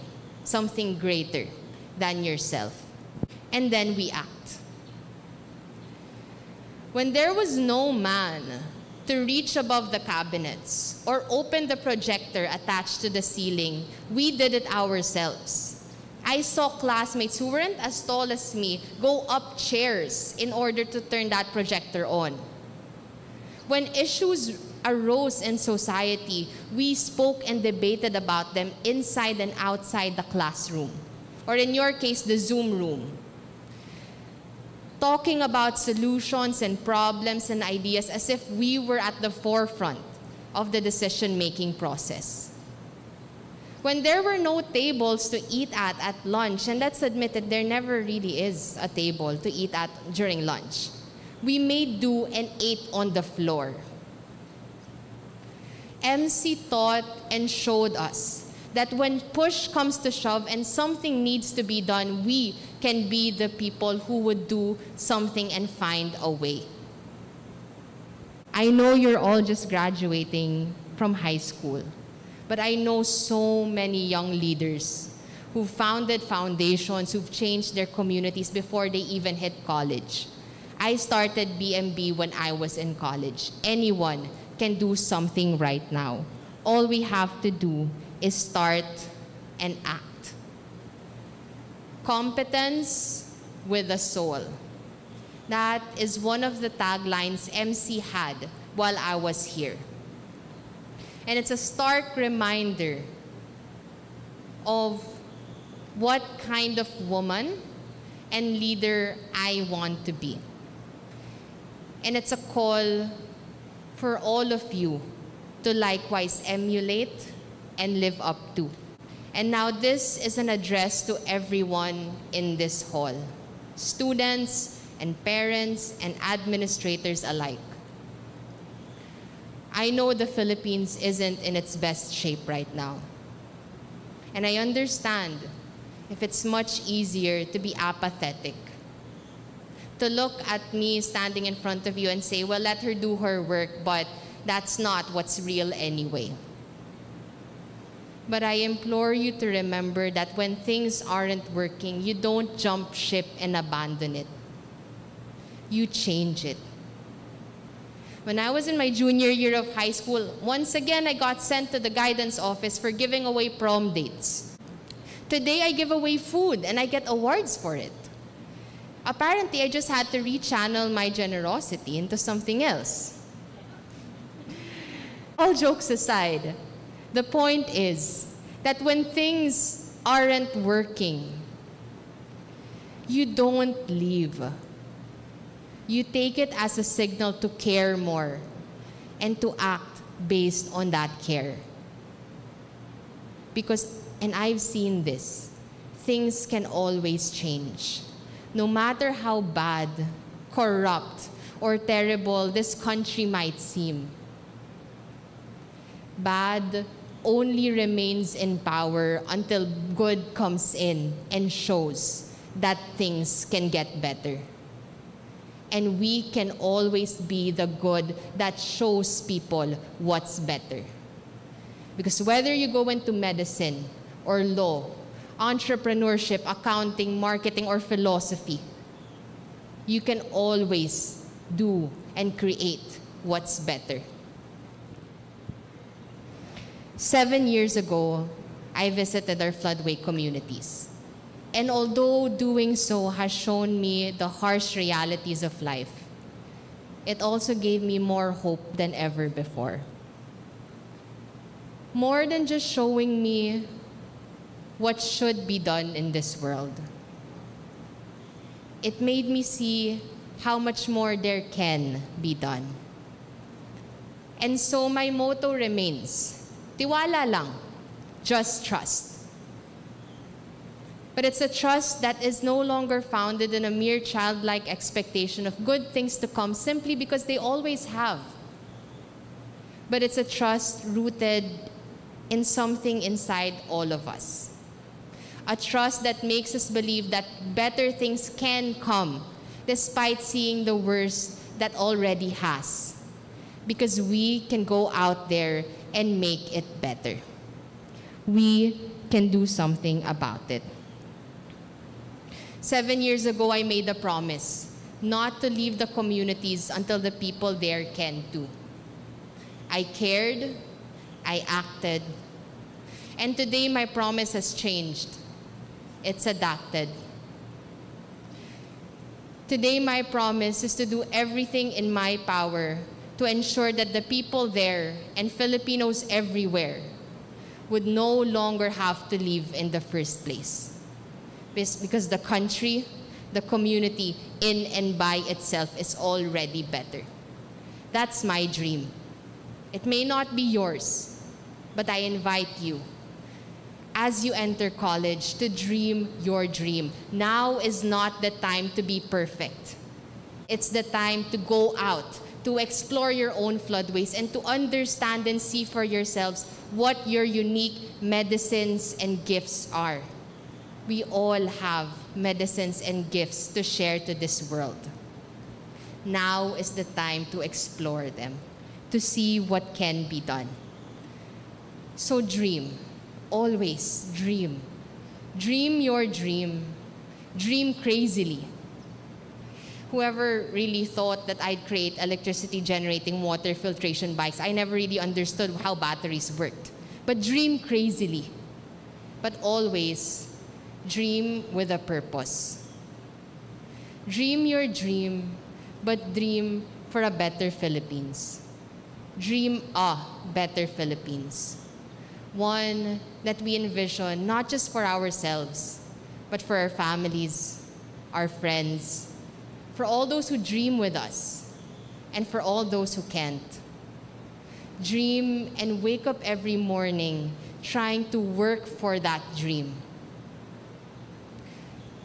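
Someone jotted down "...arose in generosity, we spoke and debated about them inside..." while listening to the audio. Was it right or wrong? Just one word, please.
wrong.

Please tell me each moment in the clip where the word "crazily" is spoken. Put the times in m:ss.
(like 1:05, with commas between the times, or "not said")
6:17, 6:27.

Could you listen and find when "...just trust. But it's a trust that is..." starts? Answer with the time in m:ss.
4:28.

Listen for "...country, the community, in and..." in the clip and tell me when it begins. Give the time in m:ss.
5:32.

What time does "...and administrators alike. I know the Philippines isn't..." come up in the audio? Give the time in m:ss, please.
2:06.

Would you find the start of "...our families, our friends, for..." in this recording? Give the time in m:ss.
6:46.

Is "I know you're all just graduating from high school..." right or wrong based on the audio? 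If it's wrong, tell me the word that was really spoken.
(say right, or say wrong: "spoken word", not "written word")
right.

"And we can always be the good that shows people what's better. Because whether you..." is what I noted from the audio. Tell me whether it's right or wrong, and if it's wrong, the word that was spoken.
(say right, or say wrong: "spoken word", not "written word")
right.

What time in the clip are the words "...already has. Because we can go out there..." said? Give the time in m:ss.
4:51.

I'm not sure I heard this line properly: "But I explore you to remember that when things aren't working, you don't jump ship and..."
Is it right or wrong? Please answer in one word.
wrong.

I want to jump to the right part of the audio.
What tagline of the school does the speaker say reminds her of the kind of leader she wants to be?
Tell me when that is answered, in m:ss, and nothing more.
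1:32.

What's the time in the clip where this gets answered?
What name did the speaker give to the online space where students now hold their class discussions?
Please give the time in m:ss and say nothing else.
0:32.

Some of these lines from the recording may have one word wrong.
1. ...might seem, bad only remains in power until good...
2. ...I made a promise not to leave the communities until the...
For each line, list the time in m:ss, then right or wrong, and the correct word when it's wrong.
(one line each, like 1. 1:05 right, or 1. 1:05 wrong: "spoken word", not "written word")
1. 3:23 right
2. 5:03 right.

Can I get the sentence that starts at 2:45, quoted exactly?
Today I give away food and I get awards for it apparently I just had to rechannel my generosity into something else.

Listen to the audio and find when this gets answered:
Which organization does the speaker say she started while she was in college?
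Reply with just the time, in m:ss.
1:21.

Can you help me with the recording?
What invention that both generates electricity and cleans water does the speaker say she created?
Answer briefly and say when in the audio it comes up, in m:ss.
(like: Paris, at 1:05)
water filtration bikes, at 6:23.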